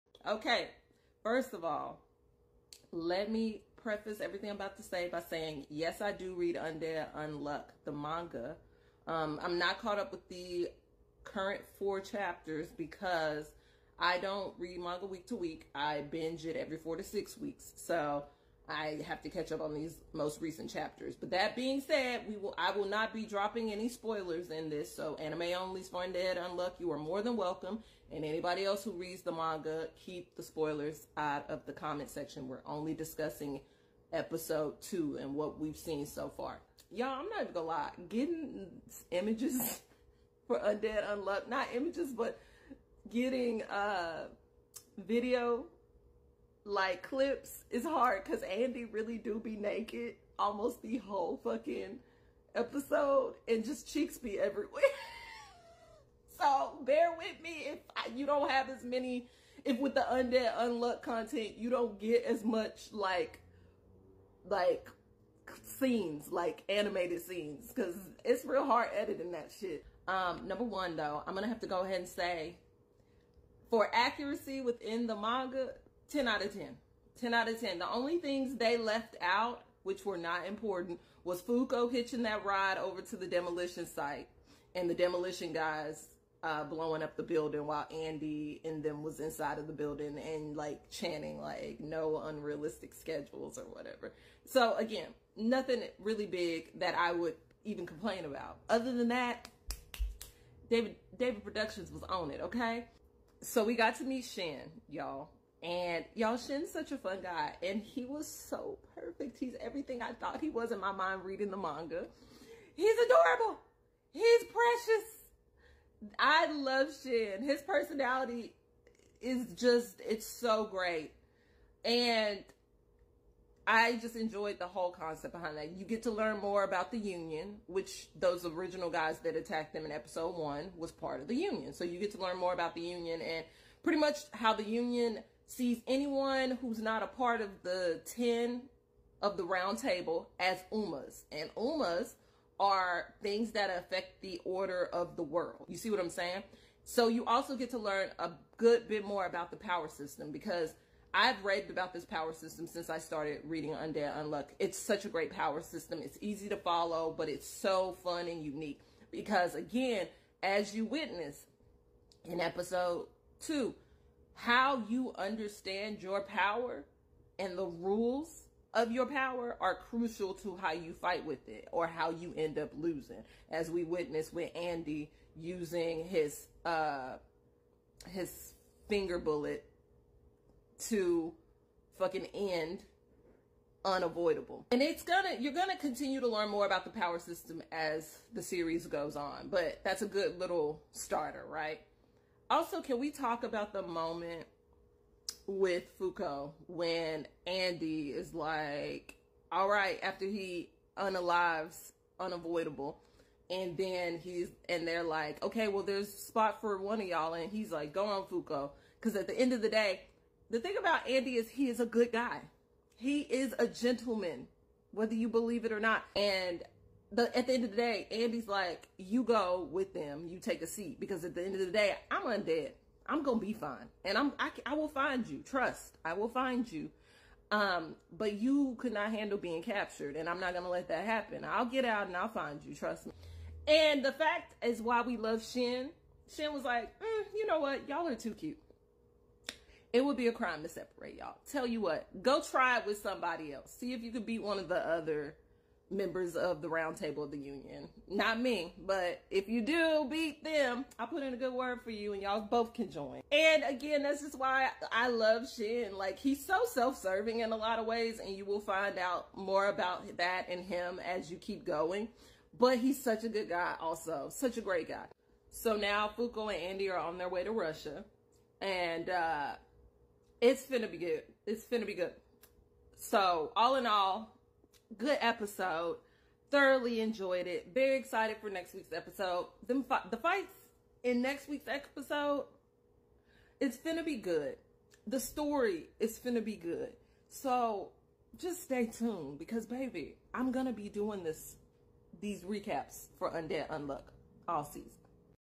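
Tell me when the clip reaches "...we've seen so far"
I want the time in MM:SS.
00:35.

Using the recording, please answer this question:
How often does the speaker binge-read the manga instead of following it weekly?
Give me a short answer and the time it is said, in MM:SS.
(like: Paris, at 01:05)
Every 4 to 6 weeks, at 00:16.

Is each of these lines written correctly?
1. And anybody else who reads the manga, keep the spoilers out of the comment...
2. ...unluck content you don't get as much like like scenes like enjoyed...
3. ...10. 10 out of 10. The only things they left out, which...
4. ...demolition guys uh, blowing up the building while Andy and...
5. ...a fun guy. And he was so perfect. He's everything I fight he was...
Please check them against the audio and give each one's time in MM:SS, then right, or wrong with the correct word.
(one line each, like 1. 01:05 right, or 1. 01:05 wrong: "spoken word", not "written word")
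1. 00:28 right
2. 01:00 wrong: "animated", not "enjoyed"
3. 01:16 right
4. 01:24 right
5. 01:46 wrong: "thought", not "fight".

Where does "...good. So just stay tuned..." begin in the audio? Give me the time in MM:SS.
04:46.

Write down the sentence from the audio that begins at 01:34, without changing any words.
So again, nothing really big that I would even complain about.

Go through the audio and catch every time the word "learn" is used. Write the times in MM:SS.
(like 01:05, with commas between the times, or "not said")
02:06, 02:12, 02:27, 03:06.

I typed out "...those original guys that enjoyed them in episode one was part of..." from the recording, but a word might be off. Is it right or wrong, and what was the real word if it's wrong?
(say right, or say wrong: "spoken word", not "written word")
wrong: "attacked", not "enjoyed".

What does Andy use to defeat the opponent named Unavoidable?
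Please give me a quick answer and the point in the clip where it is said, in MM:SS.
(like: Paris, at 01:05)
Finger bullet, at 02:58.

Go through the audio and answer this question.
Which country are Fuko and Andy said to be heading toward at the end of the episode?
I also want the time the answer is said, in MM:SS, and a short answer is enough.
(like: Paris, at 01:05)
Russia, at 04:27.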